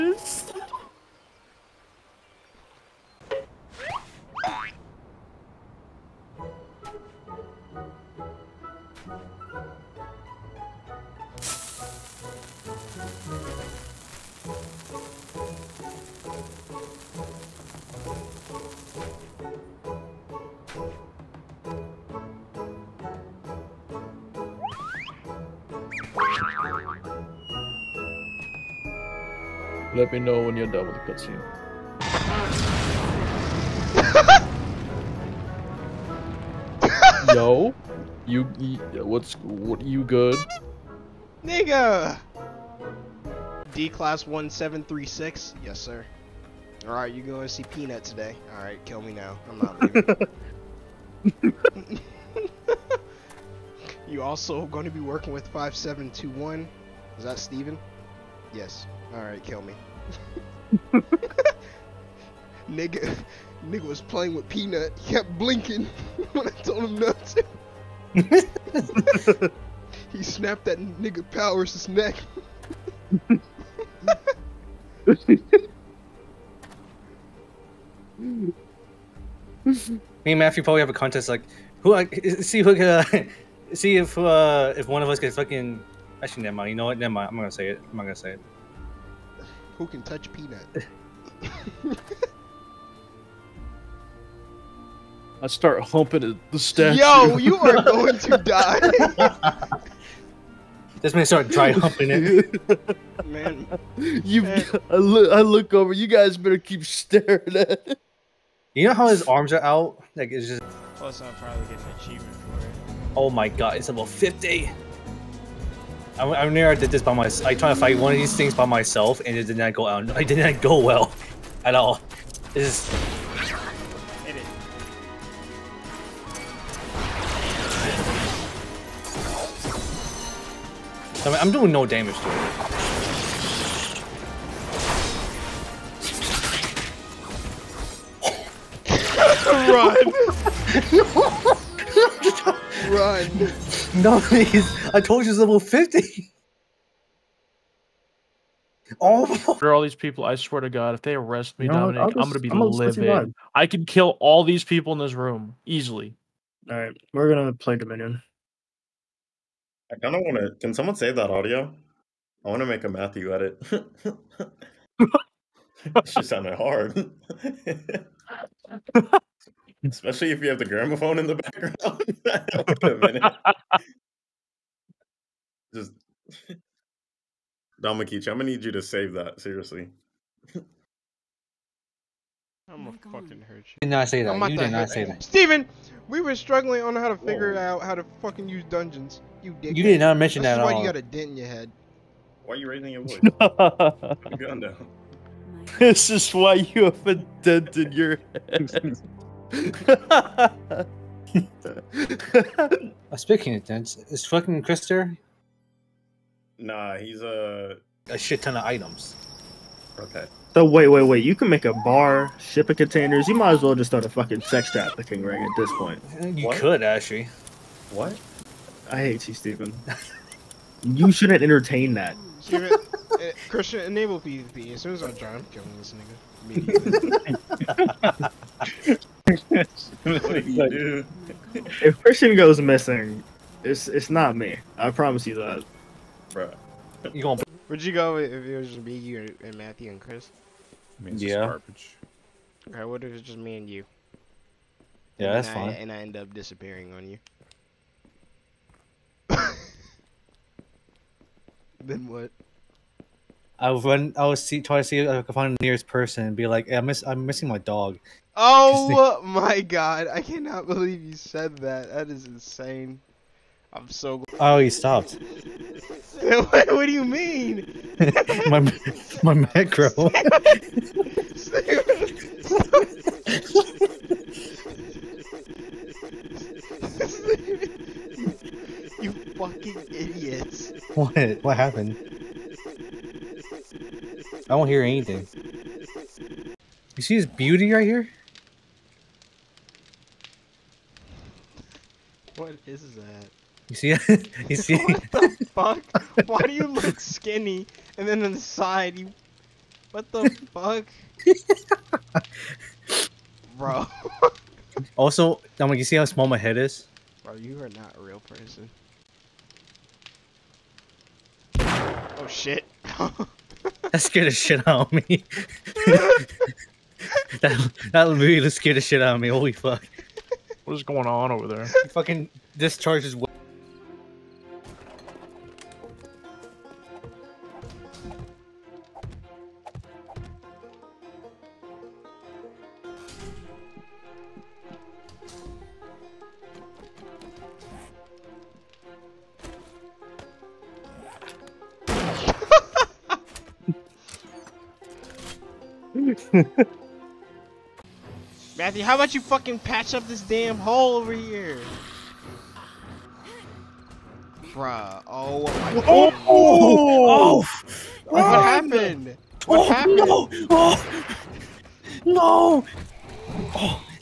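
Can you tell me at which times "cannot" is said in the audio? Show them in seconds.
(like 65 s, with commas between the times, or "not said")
260 s.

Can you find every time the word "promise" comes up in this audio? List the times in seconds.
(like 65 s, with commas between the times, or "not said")
234 s.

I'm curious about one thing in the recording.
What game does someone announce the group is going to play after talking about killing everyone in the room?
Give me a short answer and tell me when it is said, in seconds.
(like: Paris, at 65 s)
Dominion, at 157 s.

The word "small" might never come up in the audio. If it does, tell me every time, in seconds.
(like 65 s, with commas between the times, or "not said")
306 s.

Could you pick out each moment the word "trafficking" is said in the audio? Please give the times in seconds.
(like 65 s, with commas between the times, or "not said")
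214 s.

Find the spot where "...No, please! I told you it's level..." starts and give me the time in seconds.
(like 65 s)
143 s.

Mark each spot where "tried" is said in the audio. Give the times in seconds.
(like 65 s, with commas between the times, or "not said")
117 s.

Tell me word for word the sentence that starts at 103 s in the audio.
Man, you, I look, I look over.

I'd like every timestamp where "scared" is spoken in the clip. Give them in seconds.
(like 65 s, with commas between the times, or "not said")
314 s, 318 s.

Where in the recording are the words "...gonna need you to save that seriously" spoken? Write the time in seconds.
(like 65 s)
178 s.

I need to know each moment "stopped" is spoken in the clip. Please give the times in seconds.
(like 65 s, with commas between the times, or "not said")
264 s.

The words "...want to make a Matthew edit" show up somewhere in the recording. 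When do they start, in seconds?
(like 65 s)
162 s.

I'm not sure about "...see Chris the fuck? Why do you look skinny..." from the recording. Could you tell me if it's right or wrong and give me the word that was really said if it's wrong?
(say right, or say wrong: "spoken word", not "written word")
wrong: "What", not "Chris".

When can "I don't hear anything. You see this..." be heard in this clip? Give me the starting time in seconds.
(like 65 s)
284 s.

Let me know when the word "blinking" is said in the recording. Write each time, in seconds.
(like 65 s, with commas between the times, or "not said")
65 s.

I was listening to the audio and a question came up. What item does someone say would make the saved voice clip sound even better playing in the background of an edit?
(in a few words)
gramophone.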